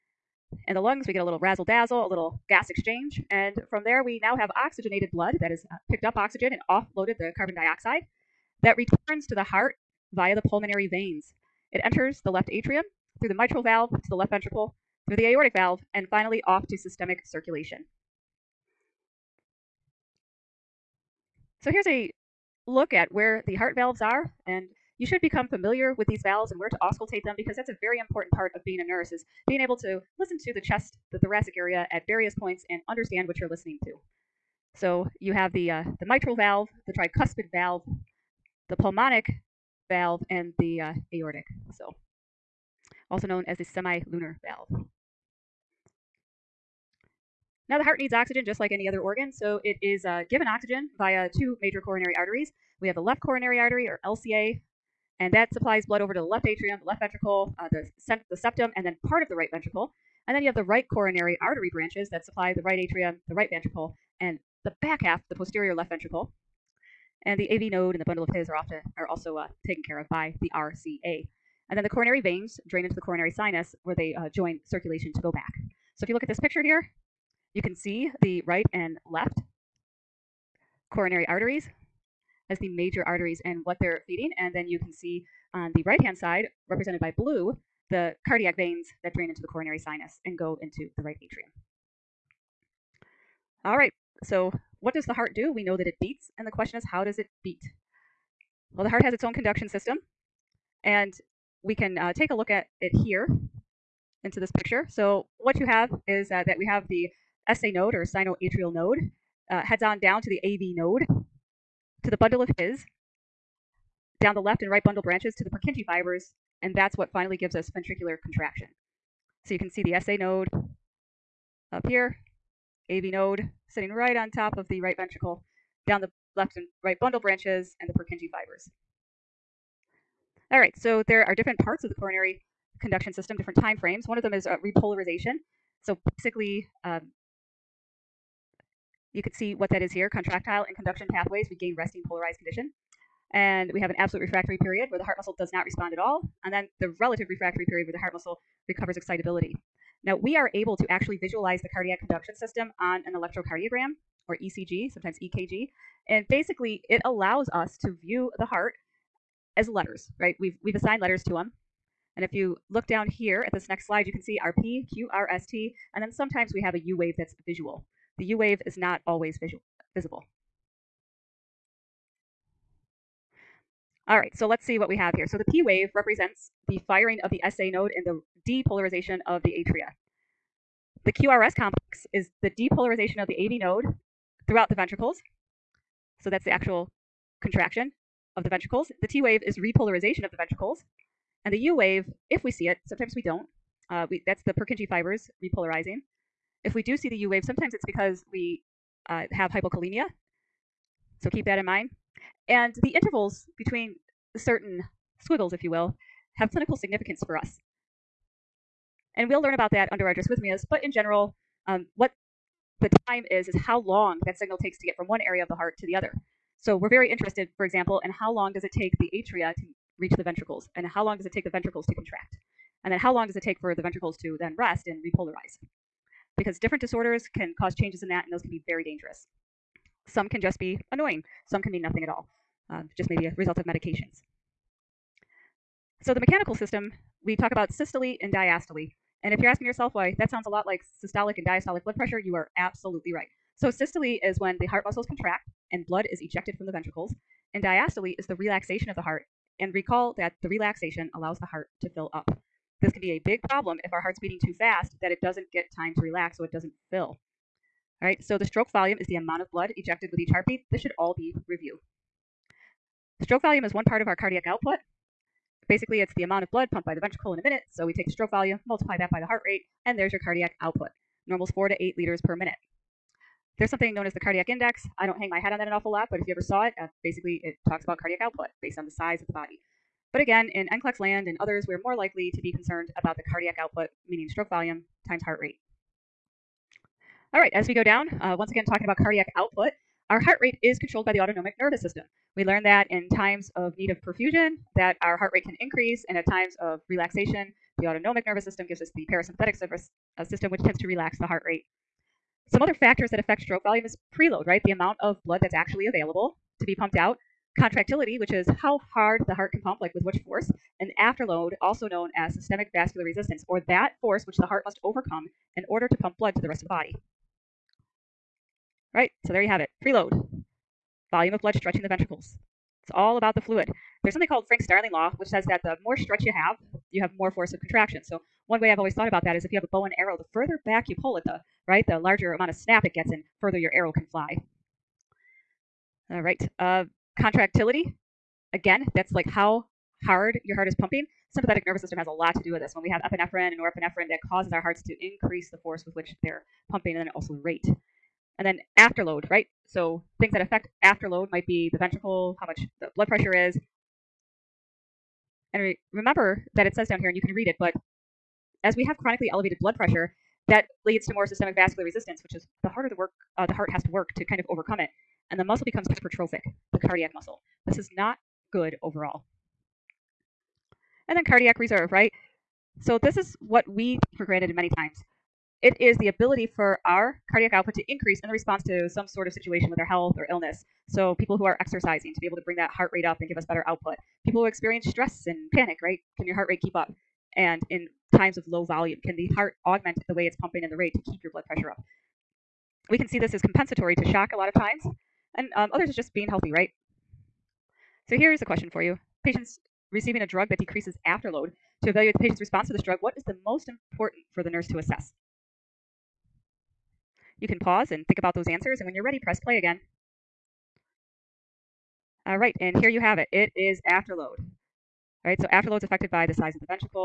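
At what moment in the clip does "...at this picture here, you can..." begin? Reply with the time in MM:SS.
01:16.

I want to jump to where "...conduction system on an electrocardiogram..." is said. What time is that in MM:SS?
02:31.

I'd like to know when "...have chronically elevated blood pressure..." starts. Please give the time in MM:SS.
05:58.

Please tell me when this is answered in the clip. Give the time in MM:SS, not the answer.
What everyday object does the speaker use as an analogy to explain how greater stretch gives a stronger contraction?
05:29.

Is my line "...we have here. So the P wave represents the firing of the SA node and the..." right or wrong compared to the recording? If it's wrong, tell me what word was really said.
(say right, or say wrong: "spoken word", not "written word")
right.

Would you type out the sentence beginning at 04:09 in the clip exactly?
And recall that the relaxation allows the heart to fill up.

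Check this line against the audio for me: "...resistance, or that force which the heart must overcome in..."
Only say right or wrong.
right.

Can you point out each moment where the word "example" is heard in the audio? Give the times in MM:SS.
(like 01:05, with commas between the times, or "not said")
03:37.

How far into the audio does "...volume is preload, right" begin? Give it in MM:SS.
05:03.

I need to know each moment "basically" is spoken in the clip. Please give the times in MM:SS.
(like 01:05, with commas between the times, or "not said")
02:16, 02:36, 04:25, 04:37.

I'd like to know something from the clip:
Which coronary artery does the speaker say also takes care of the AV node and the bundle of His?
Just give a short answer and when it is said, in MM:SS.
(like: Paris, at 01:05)
RCA, at 01:10.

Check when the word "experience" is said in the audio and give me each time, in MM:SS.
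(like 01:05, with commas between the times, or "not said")
06:24.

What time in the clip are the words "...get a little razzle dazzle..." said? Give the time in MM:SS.
00:01.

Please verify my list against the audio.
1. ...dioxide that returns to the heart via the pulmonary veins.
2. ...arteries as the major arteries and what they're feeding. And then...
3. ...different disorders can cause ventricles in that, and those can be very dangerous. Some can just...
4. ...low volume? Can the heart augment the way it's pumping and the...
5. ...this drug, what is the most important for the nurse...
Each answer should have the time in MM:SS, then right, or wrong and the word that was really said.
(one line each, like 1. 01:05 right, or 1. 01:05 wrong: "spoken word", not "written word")
1. 00:07 right
2. 01:21 right
3. 03:46 wrong: "changes", not "ventricles"
4. 06:28 right
5. 06:42 right.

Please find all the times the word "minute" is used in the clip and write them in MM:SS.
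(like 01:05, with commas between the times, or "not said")
04:27, 04:32.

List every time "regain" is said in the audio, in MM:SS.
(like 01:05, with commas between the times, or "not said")
02:21.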